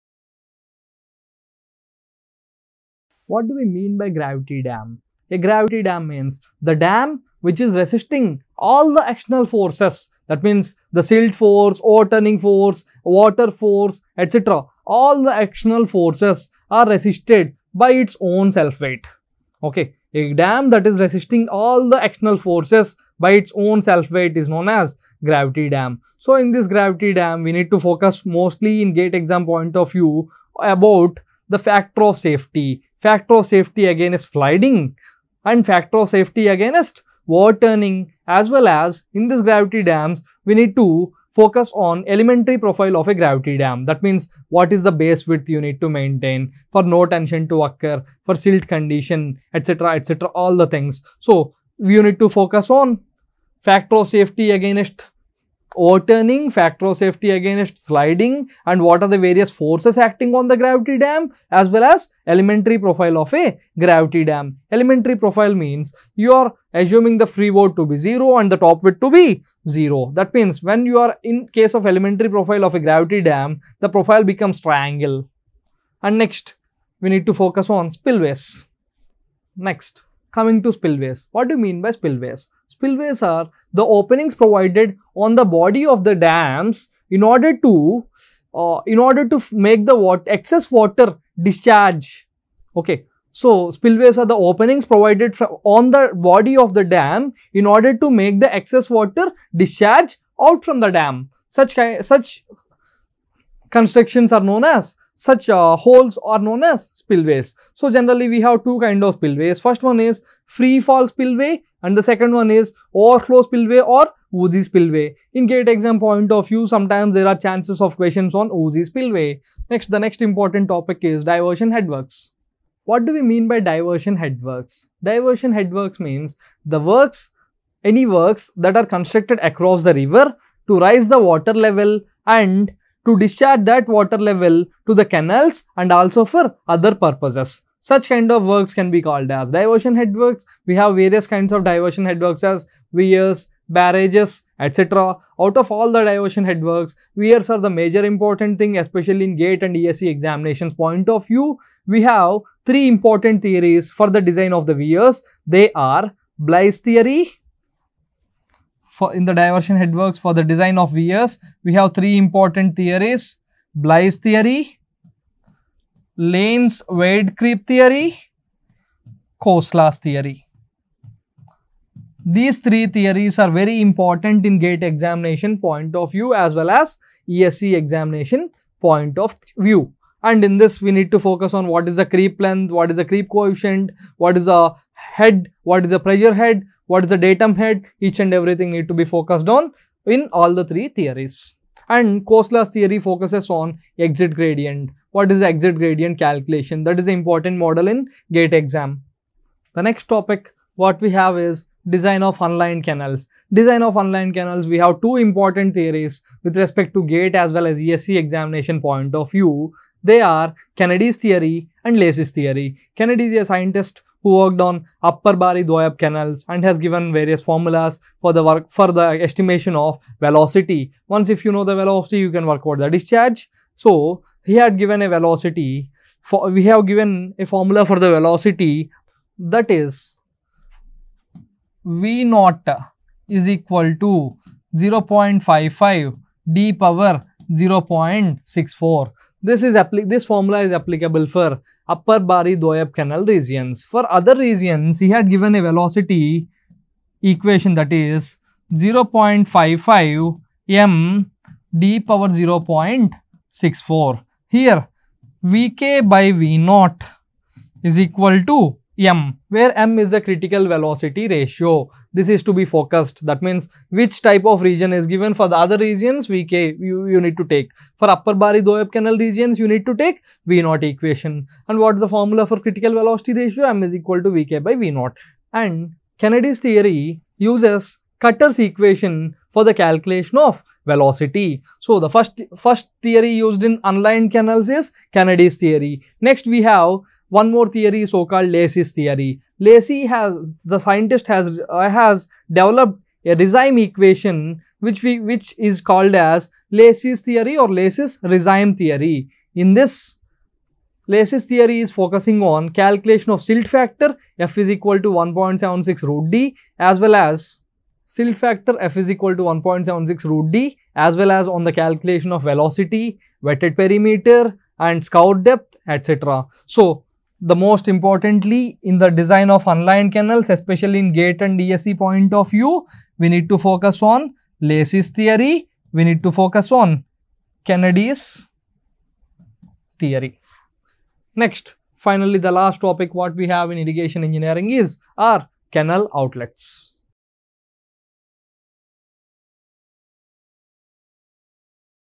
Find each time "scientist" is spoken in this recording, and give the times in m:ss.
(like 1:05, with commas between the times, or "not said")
3:33, 4:50.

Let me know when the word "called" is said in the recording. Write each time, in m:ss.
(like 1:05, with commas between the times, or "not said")
2:19, 4:48, 4:55.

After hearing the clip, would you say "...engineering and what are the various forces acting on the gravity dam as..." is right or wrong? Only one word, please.
wrong.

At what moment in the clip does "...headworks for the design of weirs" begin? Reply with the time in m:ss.
2:39.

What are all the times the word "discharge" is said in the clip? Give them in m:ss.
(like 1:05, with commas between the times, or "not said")
1:31, 1:39, 2:13, 3:42.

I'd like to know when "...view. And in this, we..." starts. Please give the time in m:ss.
2:59.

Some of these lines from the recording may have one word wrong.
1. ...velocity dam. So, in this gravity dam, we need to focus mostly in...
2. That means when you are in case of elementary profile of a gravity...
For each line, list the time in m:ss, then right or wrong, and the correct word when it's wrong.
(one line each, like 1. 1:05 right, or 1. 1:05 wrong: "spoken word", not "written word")
1. 0:25 wrong: "gravity", not "velocity"
2. 1:10 right.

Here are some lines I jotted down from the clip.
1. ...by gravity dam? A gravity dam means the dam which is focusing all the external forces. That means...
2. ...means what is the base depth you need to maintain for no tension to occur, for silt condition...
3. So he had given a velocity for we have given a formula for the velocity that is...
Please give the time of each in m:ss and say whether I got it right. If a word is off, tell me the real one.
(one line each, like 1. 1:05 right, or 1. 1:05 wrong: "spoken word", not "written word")
1. 0:03 wrong: "resisting", not "focusing"
2. 0:44 wrong: "width", not "depth"
3. 3:43 right.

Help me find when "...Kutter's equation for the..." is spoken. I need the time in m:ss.
4:38.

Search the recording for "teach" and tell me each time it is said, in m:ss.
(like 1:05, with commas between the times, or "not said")
not said.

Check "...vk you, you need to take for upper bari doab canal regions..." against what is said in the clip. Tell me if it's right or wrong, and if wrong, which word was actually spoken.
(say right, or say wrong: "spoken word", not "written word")
right.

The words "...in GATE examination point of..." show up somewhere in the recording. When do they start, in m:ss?
2:54.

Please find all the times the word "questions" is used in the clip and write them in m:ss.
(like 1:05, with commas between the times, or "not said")
1:57.